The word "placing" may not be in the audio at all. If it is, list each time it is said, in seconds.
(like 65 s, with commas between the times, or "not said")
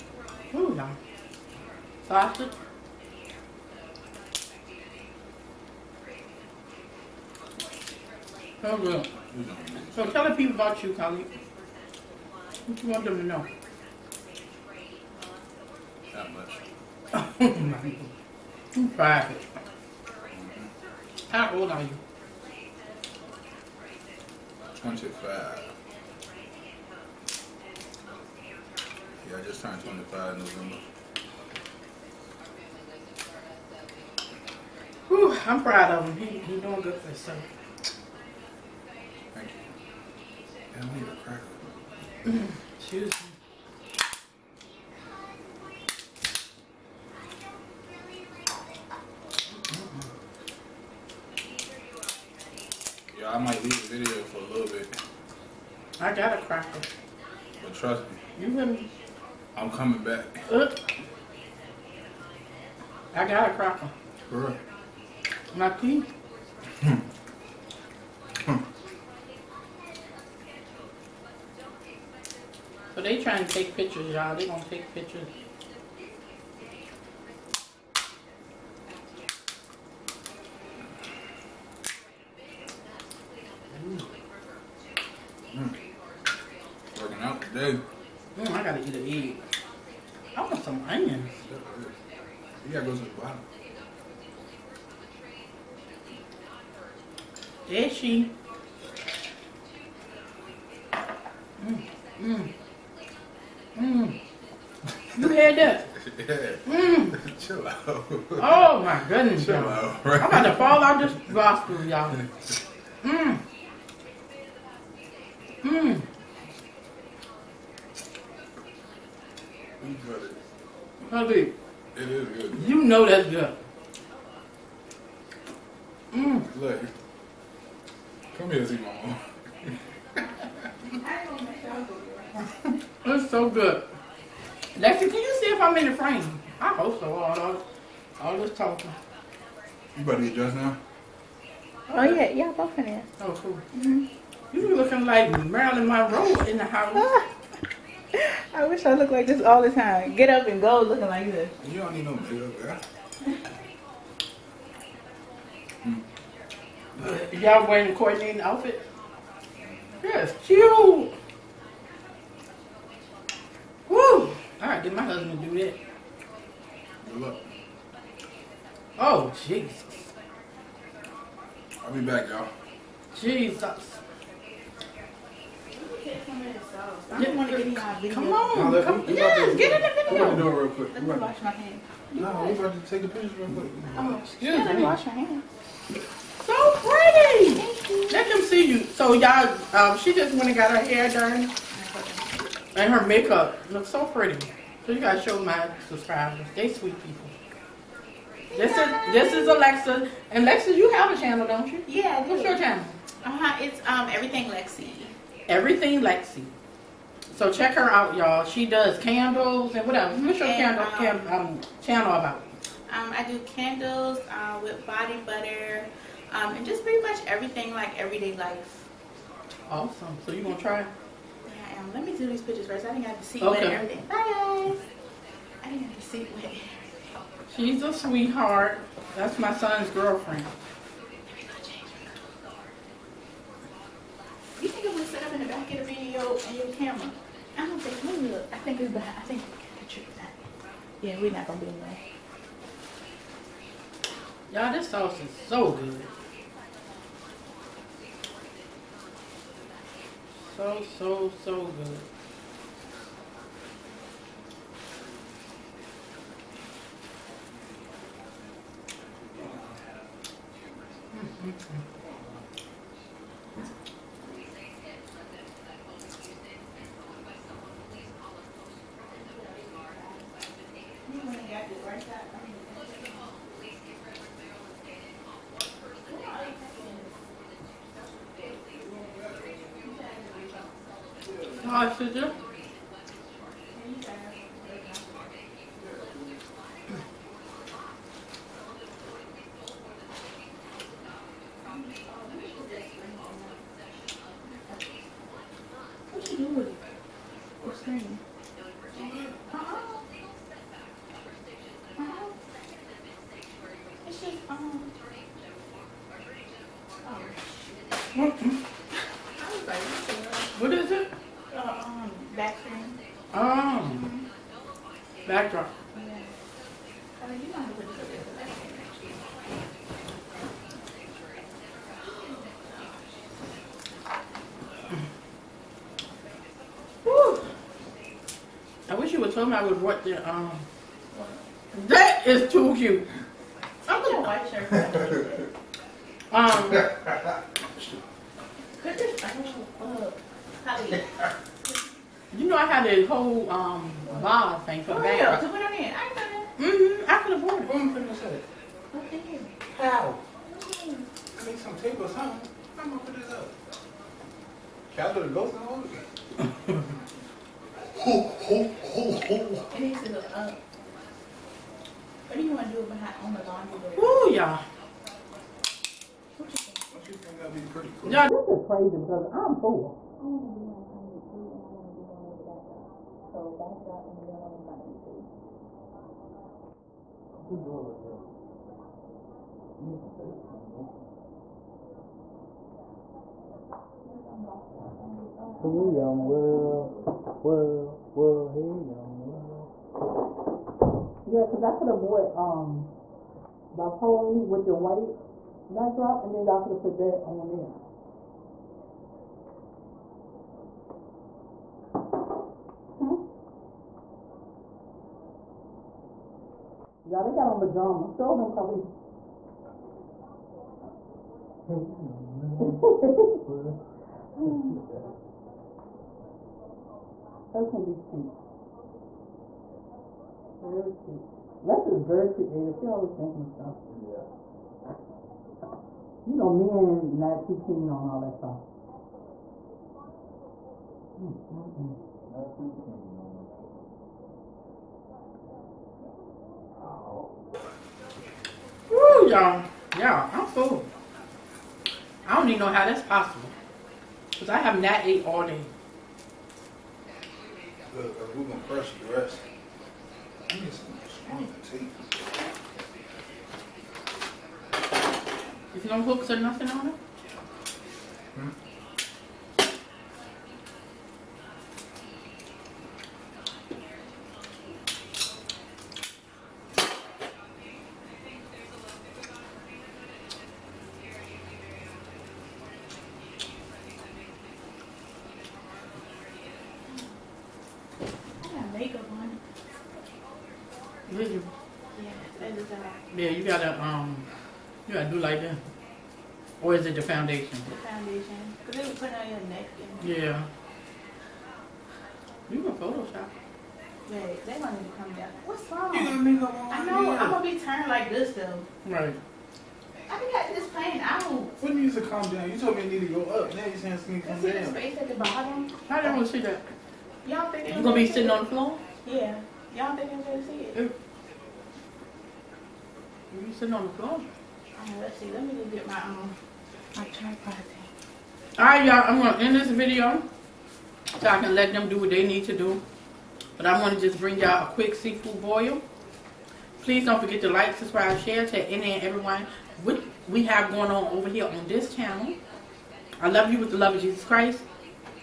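not said.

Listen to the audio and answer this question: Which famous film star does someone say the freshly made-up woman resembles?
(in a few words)
Marilyn Monroe.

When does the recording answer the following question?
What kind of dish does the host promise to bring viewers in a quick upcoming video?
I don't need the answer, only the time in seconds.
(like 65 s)
524 s.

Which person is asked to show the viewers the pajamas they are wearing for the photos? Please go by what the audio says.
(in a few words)
Khalid.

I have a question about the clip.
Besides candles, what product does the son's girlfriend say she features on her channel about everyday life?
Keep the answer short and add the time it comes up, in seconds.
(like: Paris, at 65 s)
body butter, at 214 s.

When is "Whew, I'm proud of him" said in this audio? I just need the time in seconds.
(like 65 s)
35 s.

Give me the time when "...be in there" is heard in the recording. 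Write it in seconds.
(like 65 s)
241 s.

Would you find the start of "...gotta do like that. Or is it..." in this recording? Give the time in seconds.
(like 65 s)
484 s.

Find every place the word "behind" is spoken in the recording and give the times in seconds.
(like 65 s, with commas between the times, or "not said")
238 s, 362 s.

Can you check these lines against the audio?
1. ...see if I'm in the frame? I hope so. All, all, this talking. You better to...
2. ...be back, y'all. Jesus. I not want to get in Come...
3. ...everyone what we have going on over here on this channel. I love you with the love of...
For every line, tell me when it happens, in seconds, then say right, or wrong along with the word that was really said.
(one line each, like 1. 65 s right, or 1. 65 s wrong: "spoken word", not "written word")
1. 135 s right
2. 171 s right
3. 529 s right.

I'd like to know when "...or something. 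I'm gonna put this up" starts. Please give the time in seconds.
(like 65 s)
351 s.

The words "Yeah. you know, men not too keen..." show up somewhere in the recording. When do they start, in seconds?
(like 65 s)
424 s.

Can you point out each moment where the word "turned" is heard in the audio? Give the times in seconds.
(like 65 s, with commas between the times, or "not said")
29 s, 497 s.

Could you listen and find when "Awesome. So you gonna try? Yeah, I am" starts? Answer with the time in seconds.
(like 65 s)
219 s.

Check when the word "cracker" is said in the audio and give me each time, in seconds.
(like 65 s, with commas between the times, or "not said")
41 s, 63 s.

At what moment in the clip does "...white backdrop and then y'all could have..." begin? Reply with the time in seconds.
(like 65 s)
394 s.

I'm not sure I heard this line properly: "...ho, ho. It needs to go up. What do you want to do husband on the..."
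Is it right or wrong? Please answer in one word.
wrong.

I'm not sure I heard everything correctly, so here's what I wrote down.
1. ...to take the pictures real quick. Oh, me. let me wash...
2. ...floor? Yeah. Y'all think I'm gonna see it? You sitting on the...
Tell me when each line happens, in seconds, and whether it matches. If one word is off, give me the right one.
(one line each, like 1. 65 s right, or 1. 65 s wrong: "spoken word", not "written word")
1. 182 s right
2. 508 s right.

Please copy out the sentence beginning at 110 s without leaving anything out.
I'm about to fall out this gospel, y'all.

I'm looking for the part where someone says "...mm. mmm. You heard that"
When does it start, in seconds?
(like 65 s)
102 s.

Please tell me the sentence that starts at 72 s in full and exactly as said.
So they trying to take pictures, y'all.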